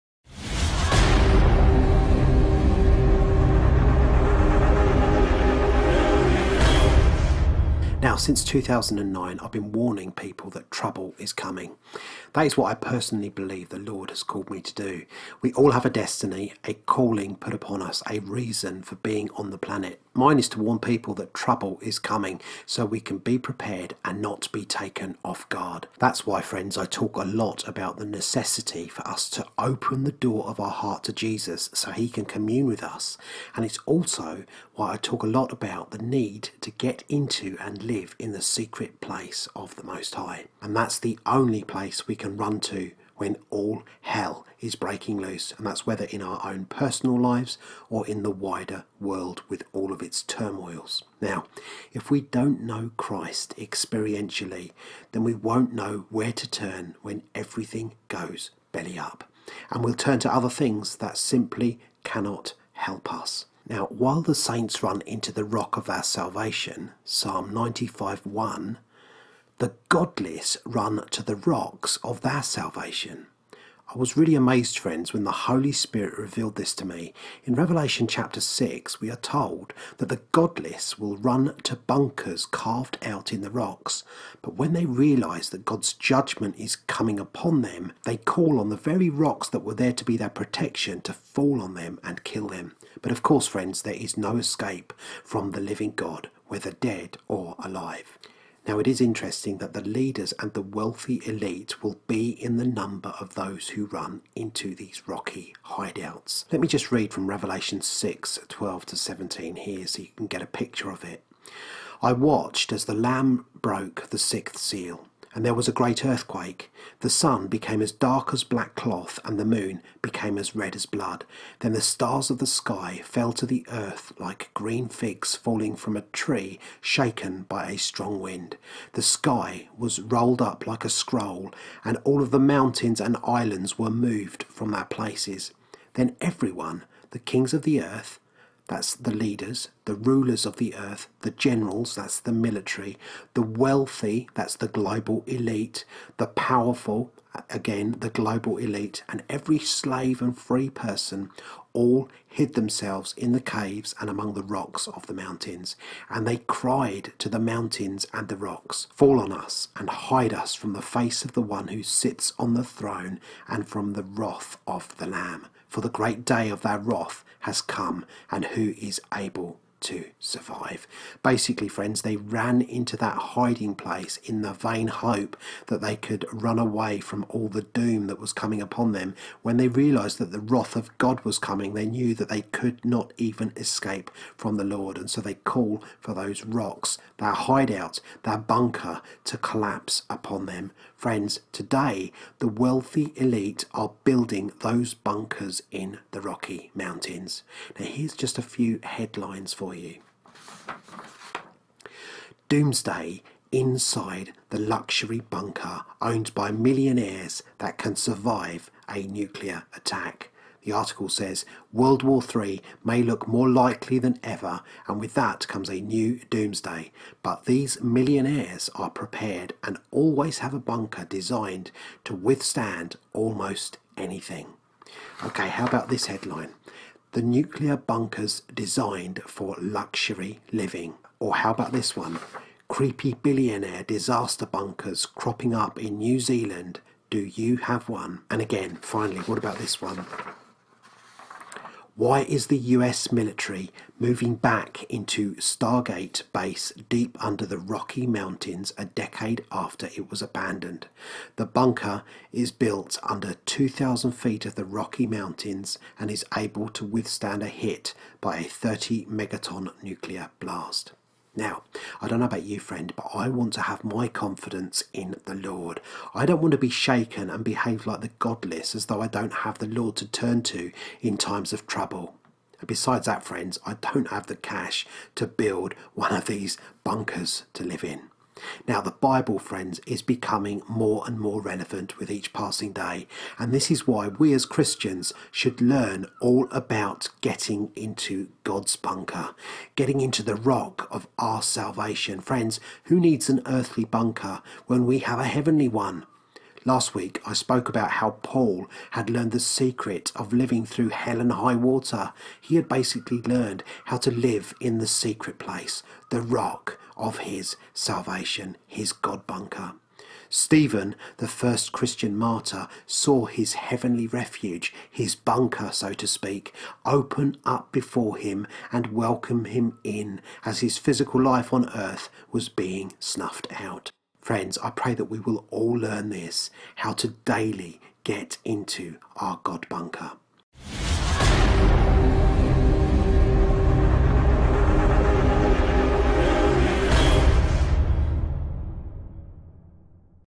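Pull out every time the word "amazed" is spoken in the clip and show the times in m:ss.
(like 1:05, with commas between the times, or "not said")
1:14.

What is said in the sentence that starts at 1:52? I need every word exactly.
I watched as the Lamb broke the sixth seal and there was a great earthquake.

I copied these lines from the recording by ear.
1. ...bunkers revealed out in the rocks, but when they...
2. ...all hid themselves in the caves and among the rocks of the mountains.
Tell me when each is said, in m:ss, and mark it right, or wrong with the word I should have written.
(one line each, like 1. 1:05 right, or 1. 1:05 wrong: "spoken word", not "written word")
1. 1:21 wrong: "carved", not "revealed"
2. 2:31 right.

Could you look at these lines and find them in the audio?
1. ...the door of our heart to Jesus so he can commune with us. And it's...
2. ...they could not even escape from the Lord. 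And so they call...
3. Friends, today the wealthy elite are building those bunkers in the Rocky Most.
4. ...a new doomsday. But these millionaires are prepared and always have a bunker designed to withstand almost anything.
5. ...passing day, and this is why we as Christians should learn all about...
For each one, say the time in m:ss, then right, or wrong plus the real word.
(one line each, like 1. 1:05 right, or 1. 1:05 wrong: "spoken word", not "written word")
1. 0:30 right
2. 3:02 right
3. 3:10 wrong: "Mountains", not "Most"
4. 3:35 right
5. 4:42 right.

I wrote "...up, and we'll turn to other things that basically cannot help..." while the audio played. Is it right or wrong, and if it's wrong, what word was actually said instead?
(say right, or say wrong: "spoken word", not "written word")
wrong: "simply", not "basically".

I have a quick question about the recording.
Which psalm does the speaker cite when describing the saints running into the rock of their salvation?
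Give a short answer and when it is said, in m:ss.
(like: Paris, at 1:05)
Psalm 95, at 1:07.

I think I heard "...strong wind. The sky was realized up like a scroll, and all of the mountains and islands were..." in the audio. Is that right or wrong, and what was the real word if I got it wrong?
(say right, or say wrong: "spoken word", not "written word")
wrong: "rolled", not "realized".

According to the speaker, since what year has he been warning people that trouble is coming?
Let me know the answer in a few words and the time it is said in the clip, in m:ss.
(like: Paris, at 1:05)
2009, at 0:08.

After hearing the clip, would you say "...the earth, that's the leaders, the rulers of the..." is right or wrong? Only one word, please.
right.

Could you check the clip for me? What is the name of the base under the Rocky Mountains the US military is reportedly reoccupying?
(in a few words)
Stargate Base.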